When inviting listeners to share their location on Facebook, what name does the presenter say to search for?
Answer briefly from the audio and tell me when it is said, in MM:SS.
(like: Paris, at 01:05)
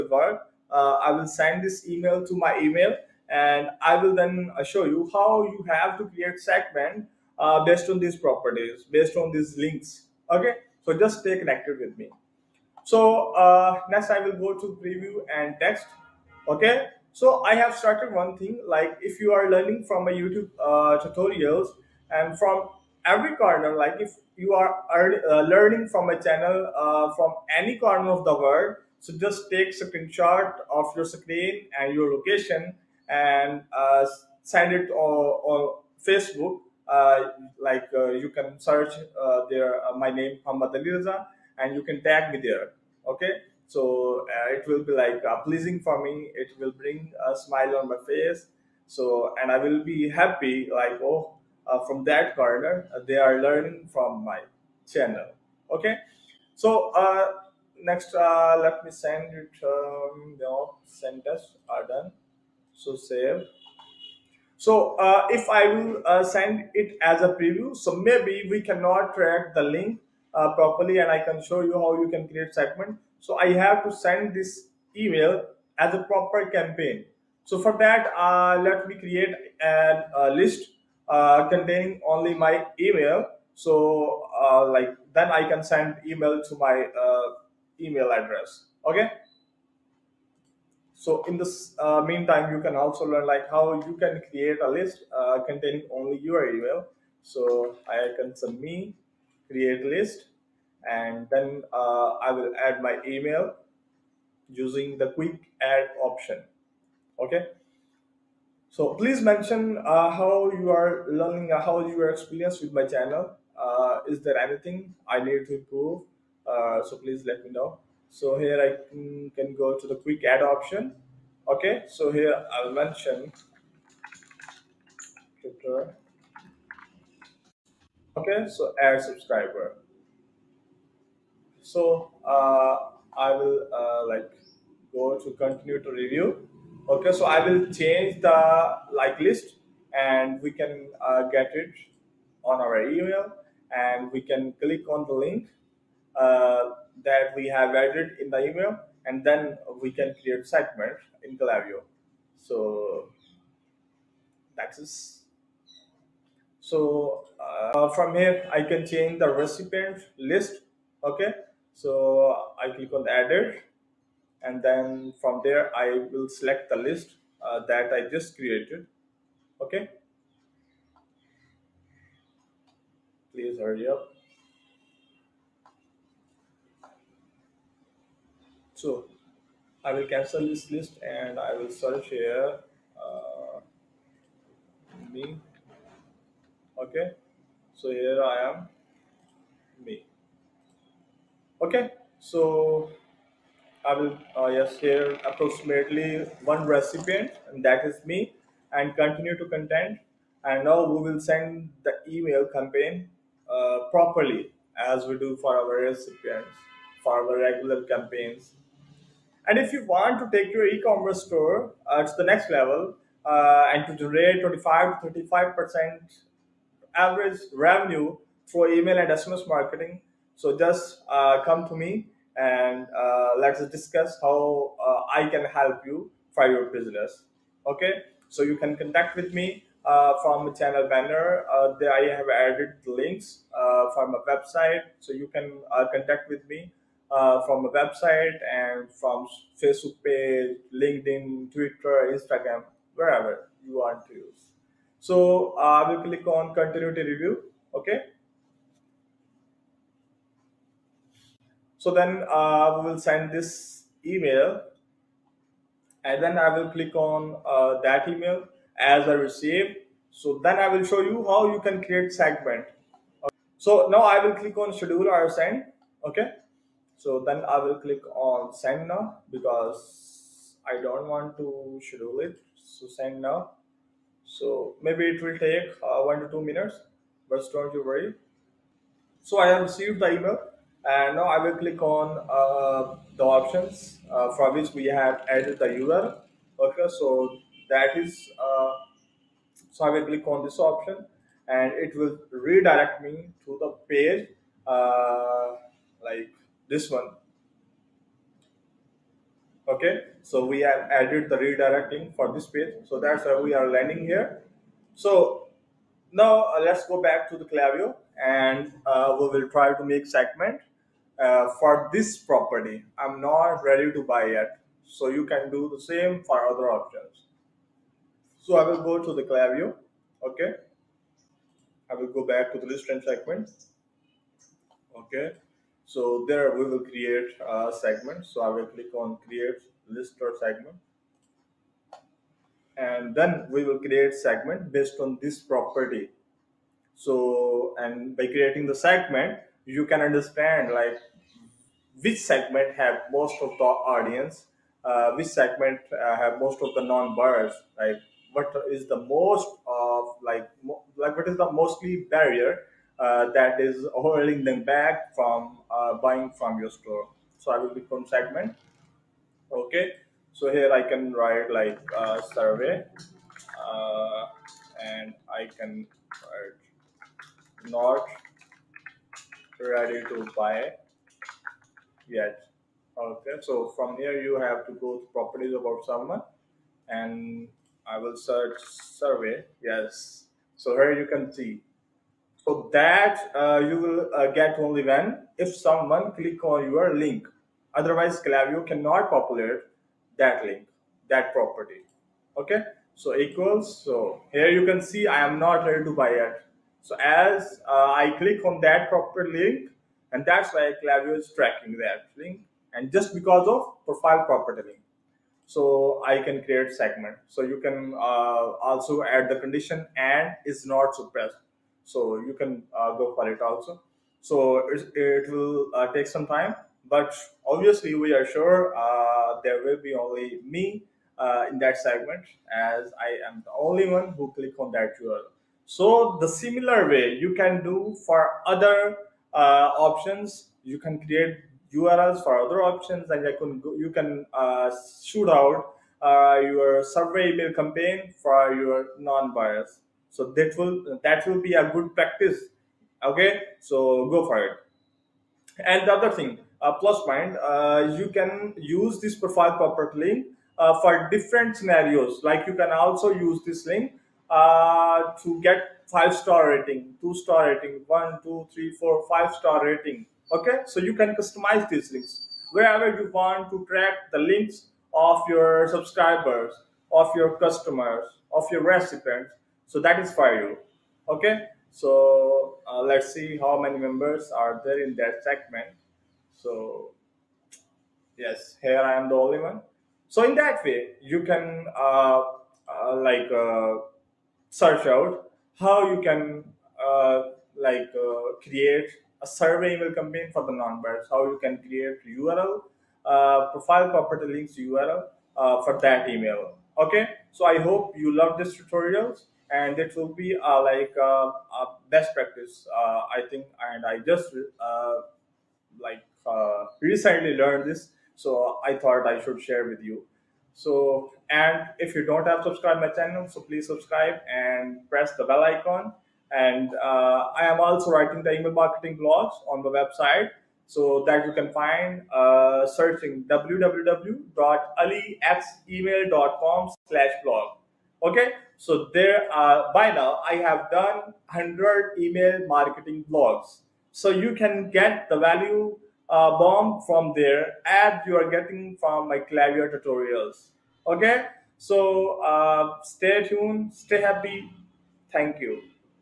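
Muhammad Ali, at 00:40.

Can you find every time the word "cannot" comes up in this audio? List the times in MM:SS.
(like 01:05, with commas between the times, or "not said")
01:08, 06:28.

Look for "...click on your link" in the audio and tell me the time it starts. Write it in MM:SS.
06:26.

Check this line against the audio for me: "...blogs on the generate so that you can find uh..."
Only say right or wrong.
wrong.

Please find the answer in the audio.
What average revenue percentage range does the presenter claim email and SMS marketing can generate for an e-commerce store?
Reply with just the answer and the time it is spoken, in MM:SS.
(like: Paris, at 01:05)
25 to 35 percent, at 03:34.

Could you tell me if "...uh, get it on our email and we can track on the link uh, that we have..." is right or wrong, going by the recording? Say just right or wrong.
wrong.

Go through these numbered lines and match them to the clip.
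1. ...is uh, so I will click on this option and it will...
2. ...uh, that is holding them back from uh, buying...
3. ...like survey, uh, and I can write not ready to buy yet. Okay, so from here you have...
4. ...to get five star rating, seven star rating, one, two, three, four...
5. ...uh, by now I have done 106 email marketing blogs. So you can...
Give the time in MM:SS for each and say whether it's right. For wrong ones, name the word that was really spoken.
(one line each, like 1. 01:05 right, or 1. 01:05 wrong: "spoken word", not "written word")
1. 04:47 right
2. 05:52 right
3. 06:01 right
4. 07:35 wrong: "two", not "seven"
5. 08:49 wrong: "100", not "106".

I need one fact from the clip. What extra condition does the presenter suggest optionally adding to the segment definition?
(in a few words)
Is not suppressed.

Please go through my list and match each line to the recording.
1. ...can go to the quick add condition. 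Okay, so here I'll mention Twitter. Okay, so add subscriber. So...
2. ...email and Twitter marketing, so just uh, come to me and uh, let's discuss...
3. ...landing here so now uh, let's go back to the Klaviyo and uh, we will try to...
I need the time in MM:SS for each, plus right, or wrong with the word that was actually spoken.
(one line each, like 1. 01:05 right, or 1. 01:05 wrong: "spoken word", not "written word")
1. 01:59 wrong: "option", not "condition"
2. 03:38 wrong: "SMS", not "Twitter"
3. 05:03 right.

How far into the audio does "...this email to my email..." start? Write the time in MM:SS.
00:01.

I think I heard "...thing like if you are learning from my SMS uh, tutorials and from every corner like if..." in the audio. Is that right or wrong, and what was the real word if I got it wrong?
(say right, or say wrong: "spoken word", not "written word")
wrong: "YouTube", not "SMS".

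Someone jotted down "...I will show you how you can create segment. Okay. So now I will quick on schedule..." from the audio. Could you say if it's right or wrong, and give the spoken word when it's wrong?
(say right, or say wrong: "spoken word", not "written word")
wrong: "click", not "quick".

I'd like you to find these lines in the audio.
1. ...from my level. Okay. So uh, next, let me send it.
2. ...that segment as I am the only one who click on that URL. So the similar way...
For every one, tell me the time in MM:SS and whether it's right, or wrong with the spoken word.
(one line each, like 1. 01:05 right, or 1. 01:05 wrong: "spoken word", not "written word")
1. 00:53 wrong: "channel", not "level"
2. 07:01 right.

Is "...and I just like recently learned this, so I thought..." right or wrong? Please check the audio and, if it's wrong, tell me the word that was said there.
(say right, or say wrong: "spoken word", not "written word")
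right.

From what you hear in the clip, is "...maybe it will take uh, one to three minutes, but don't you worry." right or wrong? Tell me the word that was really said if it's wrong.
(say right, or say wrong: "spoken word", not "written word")
wrong: "two", not "three".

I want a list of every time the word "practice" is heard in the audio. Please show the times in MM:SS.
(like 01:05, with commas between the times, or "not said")
07:21, 08:22.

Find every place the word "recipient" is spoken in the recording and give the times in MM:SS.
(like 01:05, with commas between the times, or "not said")
02:39, 03:16, 03:25, 07:48.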